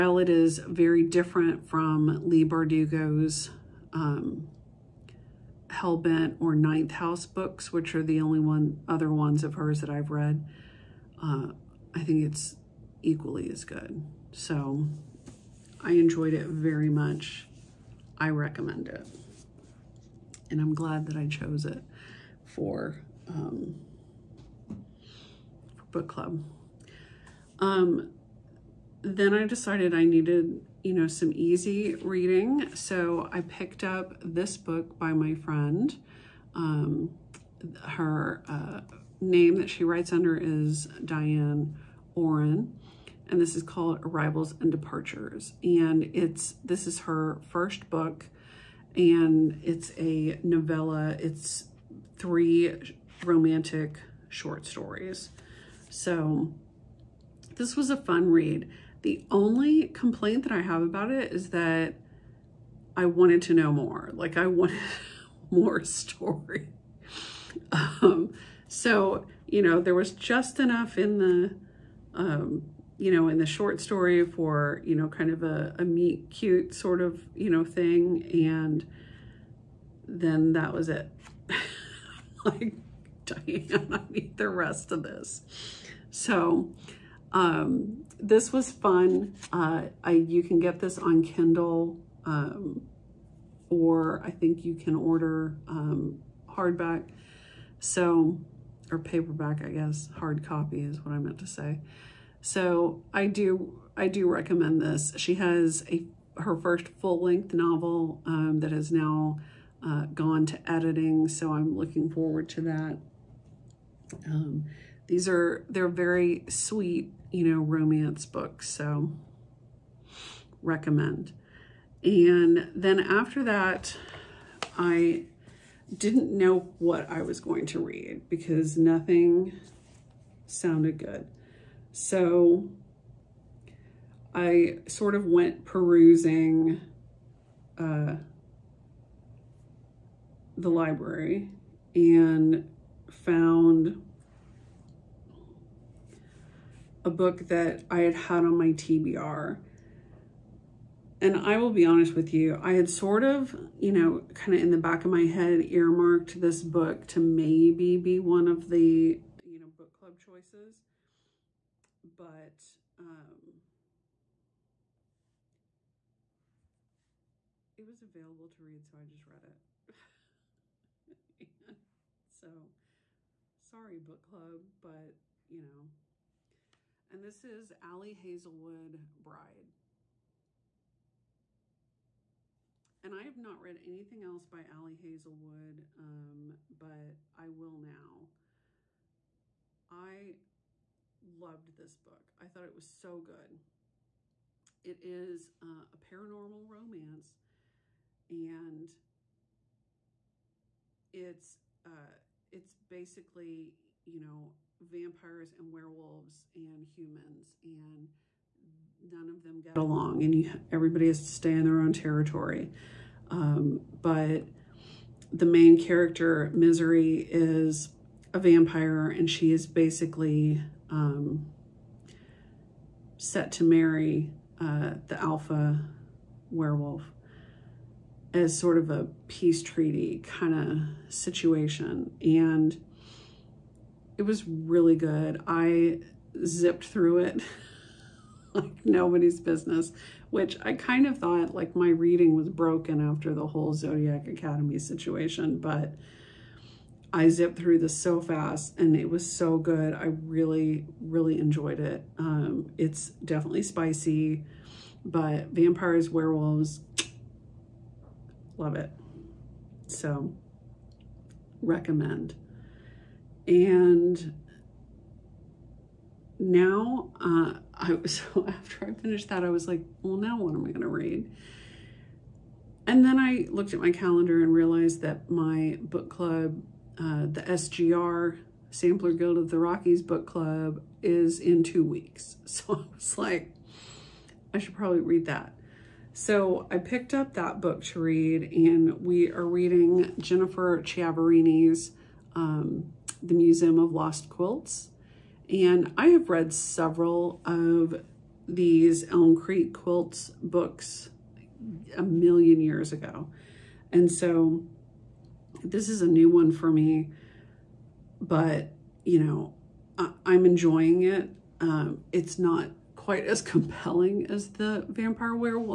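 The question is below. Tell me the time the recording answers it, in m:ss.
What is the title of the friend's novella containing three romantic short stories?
0:44.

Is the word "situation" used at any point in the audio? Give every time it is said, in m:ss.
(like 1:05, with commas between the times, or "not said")
3:51, 4:04.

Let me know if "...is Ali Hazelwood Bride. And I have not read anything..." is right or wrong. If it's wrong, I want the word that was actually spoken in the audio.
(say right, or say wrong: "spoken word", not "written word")
right.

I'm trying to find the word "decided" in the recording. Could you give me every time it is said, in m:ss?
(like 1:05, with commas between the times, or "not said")
0:29.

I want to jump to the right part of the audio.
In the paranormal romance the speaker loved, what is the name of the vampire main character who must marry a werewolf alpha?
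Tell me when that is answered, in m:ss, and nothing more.
3:36.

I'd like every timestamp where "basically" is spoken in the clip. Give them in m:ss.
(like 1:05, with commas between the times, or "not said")
3:22, 3:39.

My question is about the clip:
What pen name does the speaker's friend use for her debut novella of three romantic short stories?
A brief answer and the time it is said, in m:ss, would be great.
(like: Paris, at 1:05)
Diane Oren, at 0:41.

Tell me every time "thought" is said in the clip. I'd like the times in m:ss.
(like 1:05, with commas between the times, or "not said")
3:12, 4:01.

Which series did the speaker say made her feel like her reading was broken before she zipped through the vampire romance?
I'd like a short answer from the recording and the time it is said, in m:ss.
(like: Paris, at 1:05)
Zodiac Academy, at 4:03.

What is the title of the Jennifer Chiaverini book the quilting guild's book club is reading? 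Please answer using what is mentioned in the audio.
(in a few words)
The Museum of Lost Quilts.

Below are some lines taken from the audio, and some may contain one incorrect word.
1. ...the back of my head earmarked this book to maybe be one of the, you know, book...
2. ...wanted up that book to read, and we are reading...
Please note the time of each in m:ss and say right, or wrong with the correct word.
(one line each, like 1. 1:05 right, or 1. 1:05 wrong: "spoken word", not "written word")
1. 2:34 right
2. 4:46 wrong: "picked", not "wanted".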